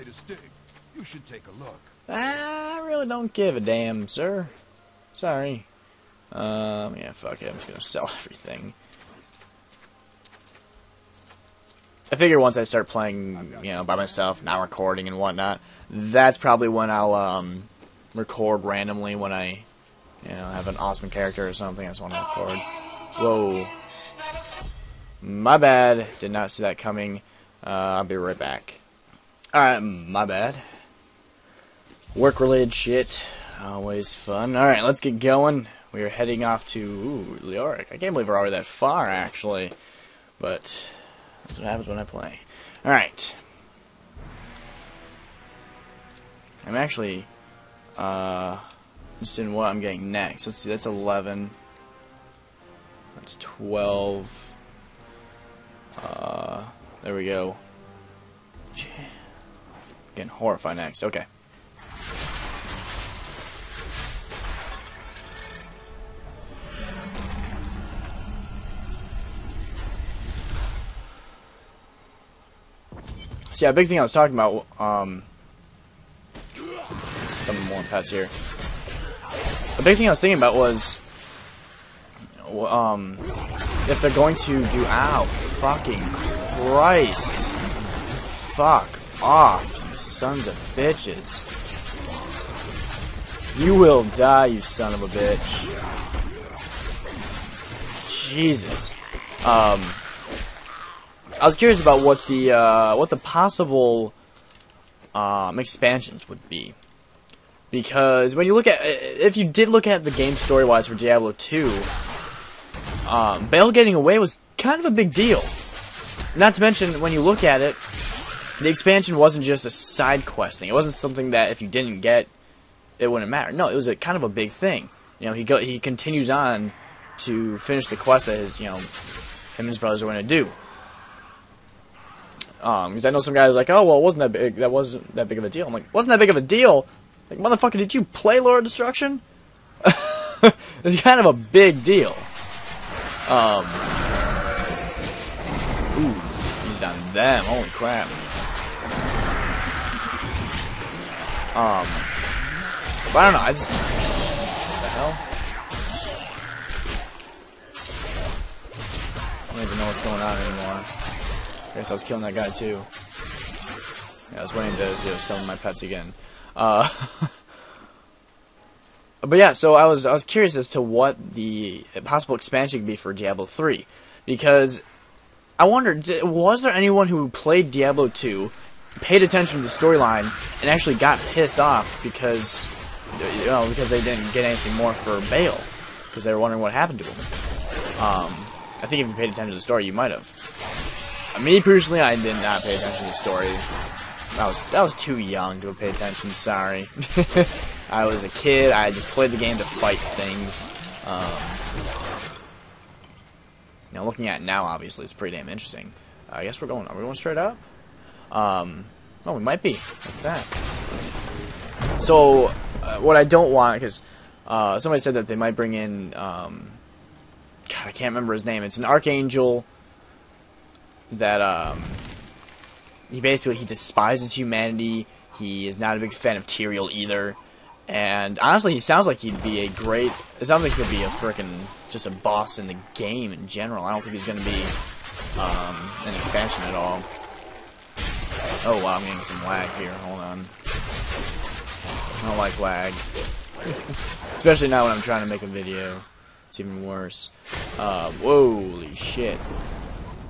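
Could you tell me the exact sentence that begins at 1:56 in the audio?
Not to mention when you look at it, the expansion wasn't just a side quest thing.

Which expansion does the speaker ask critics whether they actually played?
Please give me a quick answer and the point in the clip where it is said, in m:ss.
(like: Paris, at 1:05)
Lord of Destruction, at 2:18.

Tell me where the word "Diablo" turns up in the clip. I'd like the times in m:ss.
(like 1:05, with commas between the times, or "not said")
1:50, 2:53, 2:57.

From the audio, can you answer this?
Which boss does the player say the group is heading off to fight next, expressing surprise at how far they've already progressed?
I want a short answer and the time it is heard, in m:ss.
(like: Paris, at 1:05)
Leoric, at 0:37.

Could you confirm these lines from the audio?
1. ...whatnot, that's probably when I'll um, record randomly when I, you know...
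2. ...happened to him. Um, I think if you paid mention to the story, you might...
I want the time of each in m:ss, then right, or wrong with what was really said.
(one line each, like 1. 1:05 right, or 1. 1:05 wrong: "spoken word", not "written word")
1. 0:15 right
2. 3:06 wrong: "attention", not "mention".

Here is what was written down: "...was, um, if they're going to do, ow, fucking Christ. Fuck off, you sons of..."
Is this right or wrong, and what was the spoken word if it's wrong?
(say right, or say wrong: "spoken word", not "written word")
right.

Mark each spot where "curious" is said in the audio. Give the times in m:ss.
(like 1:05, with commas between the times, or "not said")
1:41, 2:50.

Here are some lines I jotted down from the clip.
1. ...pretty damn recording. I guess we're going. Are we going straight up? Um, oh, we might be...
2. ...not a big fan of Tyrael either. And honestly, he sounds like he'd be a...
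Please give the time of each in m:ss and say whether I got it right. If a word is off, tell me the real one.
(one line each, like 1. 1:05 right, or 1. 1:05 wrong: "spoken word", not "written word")
1. 3:25 wrong: "interesting", not "recording"
2. 3:45 right.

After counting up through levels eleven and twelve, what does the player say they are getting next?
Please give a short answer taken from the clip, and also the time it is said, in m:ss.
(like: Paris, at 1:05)
horrified, at 1:00.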